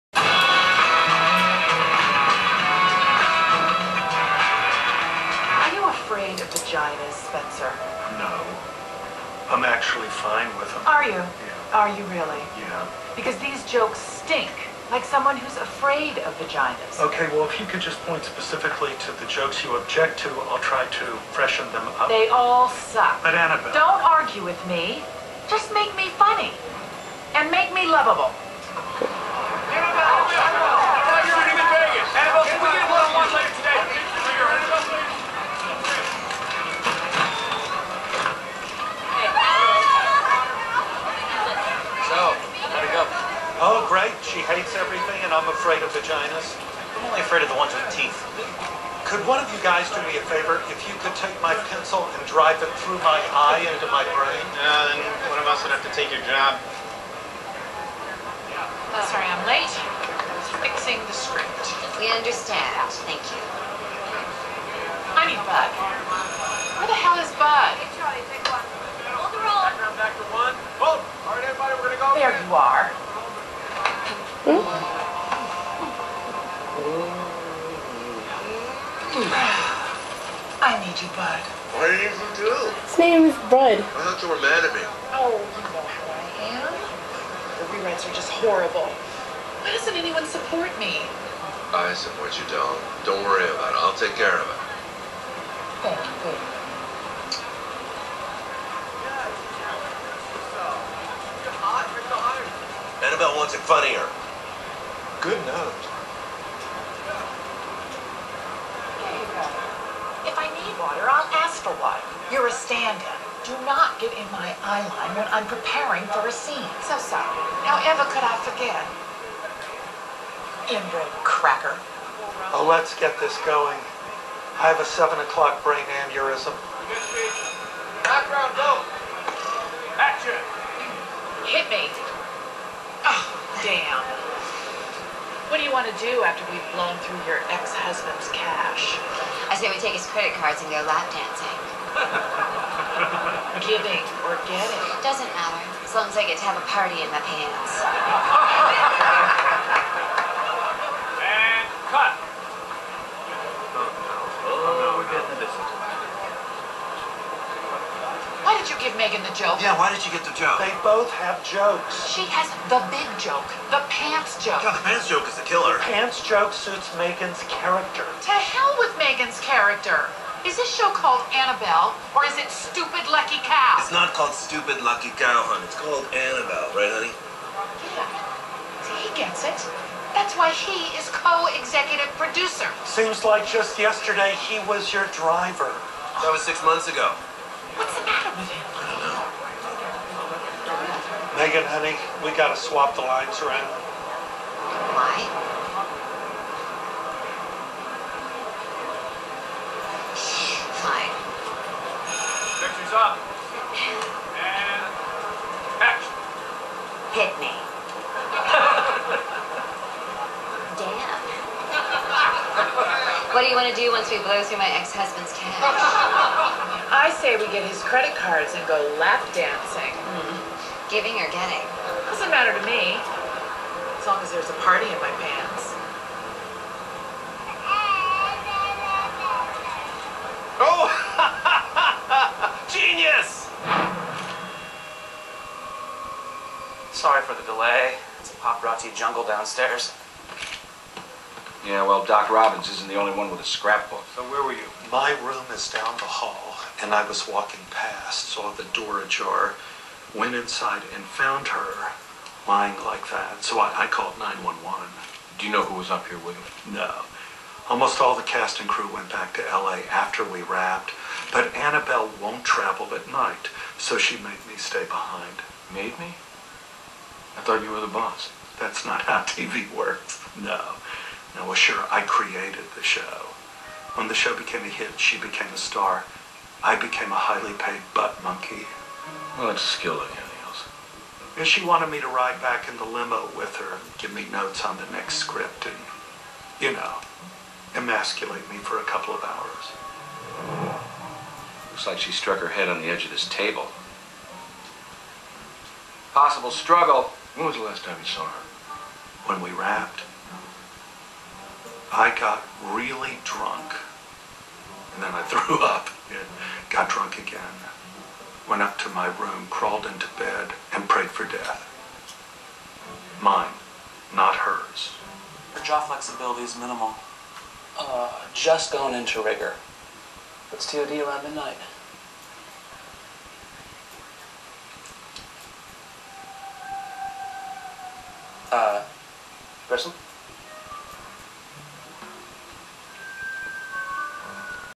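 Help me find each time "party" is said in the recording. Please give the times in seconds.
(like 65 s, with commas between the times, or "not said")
146 s, 224 s.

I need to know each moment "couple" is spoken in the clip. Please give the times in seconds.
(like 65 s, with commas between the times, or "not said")
288 s.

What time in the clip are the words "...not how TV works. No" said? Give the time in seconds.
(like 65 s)
268 s.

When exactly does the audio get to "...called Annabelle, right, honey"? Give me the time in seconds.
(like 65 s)
175 s.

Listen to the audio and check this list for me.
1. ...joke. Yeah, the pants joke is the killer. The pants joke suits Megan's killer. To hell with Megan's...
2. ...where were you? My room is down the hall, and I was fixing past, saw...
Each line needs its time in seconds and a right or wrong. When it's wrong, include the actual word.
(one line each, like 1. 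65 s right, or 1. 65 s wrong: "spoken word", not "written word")
1. 164 s wrong: "character", not "killer"
2. 244 s wrong: "walking", not "fixing".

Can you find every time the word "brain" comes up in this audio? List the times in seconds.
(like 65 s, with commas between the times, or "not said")
54 s, 125 s.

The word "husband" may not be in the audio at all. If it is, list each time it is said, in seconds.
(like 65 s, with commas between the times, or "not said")
137 s, 214 s.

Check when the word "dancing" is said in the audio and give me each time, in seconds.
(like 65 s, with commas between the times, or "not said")
141 s, 219 s.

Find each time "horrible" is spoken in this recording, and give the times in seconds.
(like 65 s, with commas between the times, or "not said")
88 s.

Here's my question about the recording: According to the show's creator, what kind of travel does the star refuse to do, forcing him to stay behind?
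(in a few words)
Travel at night.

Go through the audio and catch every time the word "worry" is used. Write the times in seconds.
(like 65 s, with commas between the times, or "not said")
93 s.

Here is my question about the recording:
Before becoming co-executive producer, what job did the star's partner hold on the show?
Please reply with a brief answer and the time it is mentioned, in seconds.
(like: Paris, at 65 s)
Driver, at 185 s.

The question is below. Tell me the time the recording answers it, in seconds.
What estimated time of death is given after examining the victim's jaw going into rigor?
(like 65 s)
320 s.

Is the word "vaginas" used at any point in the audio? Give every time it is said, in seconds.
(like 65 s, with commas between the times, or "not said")
16 s, 45 s.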